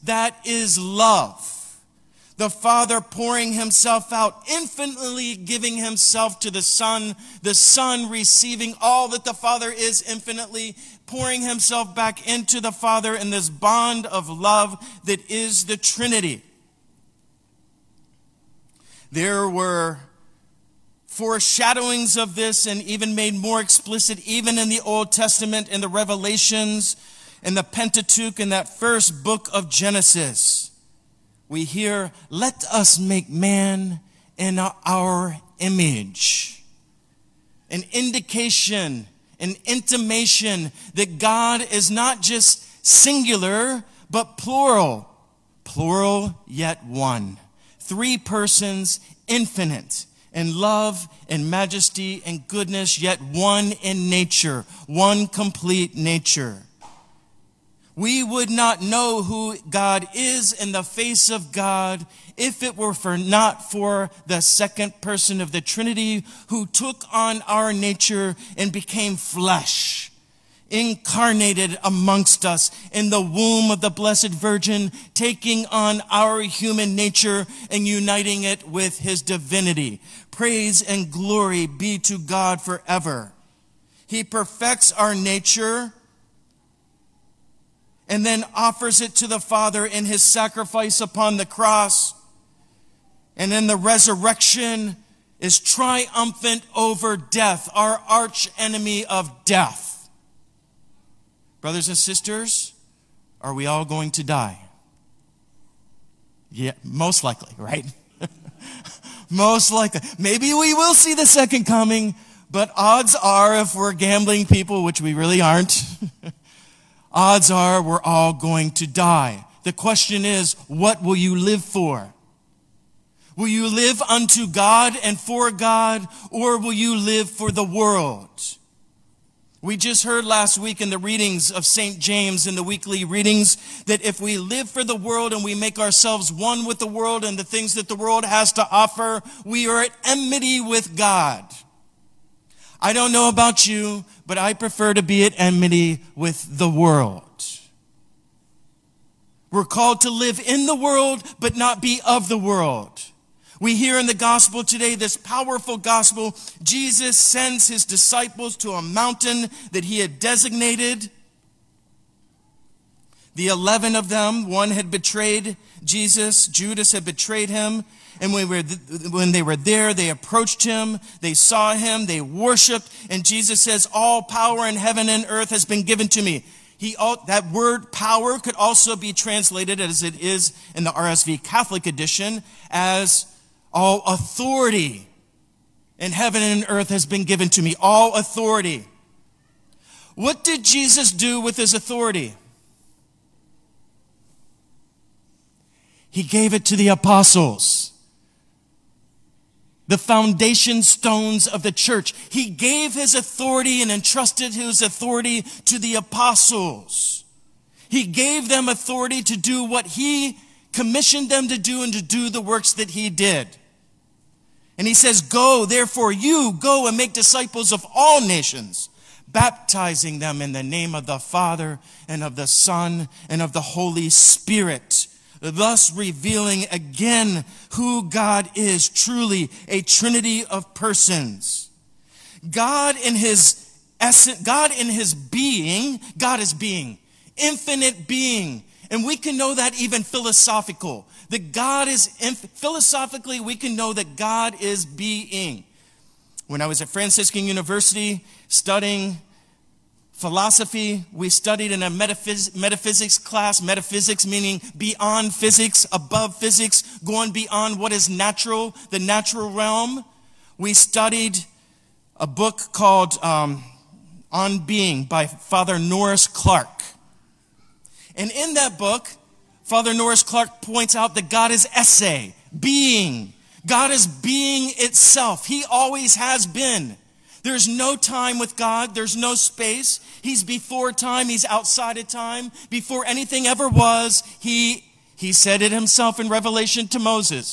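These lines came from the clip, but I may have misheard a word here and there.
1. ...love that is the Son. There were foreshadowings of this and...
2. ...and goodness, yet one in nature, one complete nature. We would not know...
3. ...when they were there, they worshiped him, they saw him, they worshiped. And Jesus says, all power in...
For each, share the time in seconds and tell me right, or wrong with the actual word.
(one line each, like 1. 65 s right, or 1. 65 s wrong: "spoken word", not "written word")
1. 14 s wrong: "Trinity", not "Son"
2. 52 s right
3. 169 s wrong: "approached", not "worshiped".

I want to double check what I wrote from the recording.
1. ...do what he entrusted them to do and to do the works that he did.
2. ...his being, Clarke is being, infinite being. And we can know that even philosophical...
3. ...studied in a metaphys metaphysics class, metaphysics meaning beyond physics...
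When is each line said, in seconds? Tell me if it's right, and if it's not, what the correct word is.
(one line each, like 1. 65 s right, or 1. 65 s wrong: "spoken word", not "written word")
1. 209 s wrong: "commissioned", not "entrusted"
2. 234 s wrong: "God", not "Clarke"
3. 251 s right.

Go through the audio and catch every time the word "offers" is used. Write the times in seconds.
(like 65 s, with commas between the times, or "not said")
88 s, 138 s.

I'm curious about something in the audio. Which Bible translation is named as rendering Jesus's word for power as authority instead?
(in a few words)
RSV Catholic edition.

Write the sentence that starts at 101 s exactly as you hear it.
Brothers and sisters, are we all going to die?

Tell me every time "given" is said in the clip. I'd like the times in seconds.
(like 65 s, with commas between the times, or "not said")
175 s, 187 s.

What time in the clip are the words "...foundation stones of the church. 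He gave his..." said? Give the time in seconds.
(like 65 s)
199 s.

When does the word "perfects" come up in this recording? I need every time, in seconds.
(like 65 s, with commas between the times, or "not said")
84 s.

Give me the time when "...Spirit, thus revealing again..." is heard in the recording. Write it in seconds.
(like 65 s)
224 s.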